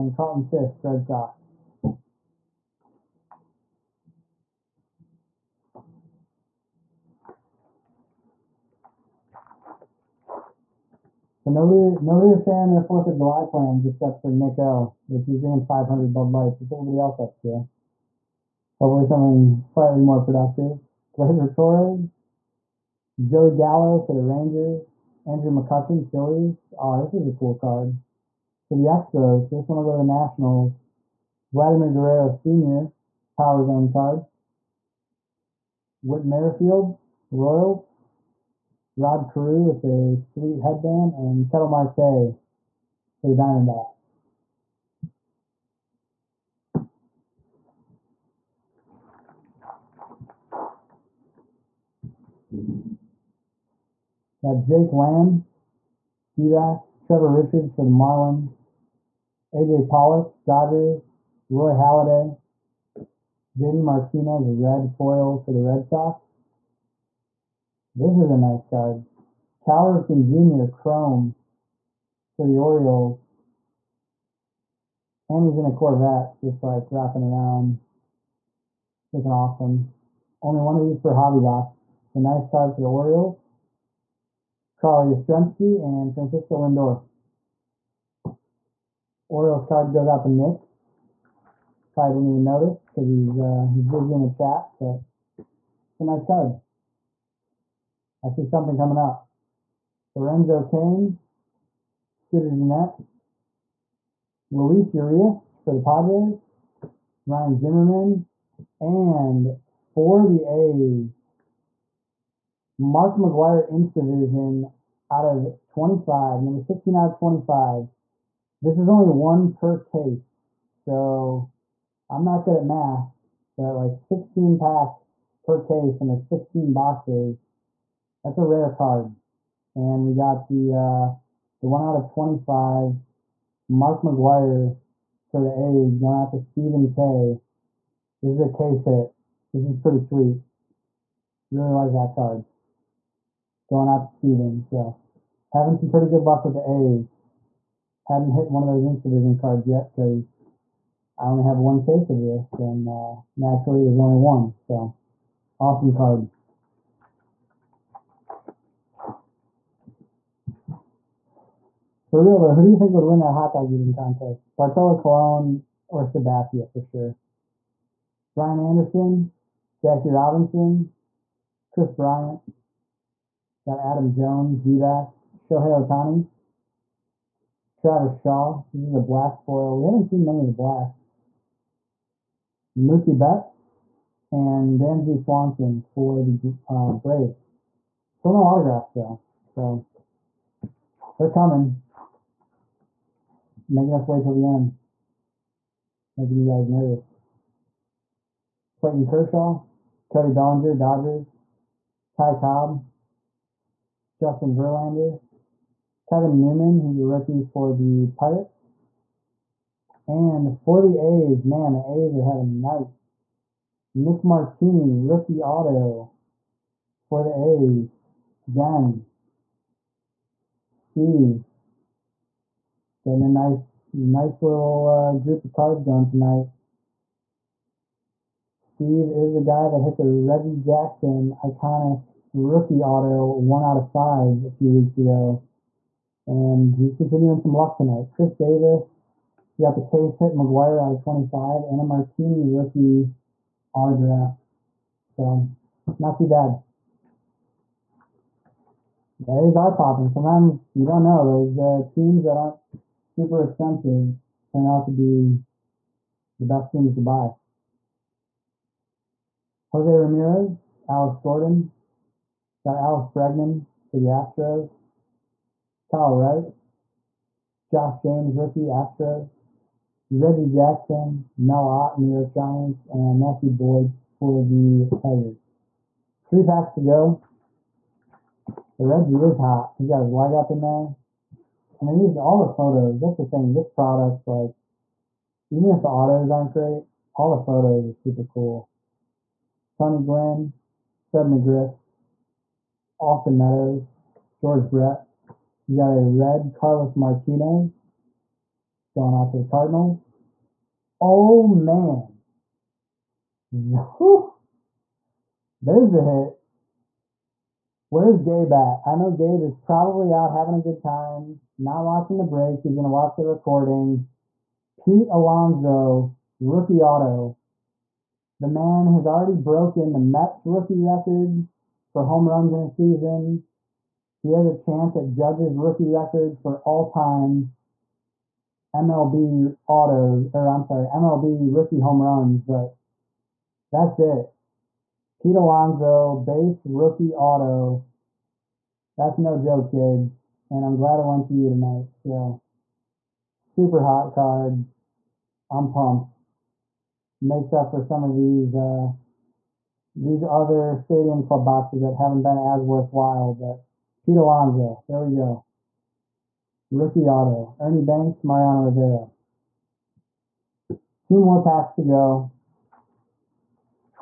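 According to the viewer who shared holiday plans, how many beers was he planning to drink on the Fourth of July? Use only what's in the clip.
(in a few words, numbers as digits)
500.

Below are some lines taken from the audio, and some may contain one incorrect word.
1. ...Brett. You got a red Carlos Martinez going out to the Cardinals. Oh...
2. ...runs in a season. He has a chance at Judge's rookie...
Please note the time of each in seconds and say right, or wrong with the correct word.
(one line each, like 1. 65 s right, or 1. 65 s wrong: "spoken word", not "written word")
1. 294 s right
2. 322 s right.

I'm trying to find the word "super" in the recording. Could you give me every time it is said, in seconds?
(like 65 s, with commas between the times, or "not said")
252 s, 287 s, 343 s.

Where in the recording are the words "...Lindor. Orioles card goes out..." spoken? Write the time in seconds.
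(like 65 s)
86 s.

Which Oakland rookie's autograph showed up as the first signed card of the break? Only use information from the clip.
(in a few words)
Nick Martini.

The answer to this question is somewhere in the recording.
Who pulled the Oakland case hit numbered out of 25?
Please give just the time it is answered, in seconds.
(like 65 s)
136 s.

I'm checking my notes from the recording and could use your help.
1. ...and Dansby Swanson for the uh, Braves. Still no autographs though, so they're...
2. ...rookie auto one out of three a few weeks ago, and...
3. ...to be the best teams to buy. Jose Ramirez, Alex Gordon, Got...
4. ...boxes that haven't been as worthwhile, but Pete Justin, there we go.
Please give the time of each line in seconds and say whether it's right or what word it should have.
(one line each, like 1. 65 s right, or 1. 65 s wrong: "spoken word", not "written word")
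1. 184 s right
2. 232 s wrong: "five", not "three"
3. 254 s right
4. 351 s wrong: "Alonso", not "Justin".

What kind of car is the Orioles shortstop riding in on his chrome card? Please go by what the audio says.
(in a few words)
Corvette.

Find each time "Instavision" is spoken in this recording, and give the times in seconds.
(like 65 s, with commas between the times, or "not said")
113 s, 148 s.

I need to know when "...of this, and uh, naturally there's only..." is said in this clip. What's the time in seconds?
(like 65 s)
152 s.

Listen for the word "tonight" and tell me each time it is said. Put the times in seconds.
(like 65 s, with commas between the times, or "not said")
226 s, 237 s, 341 s.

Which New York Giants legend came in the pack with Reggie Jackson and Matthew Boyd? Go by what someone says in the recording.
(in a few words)
Mel Ott.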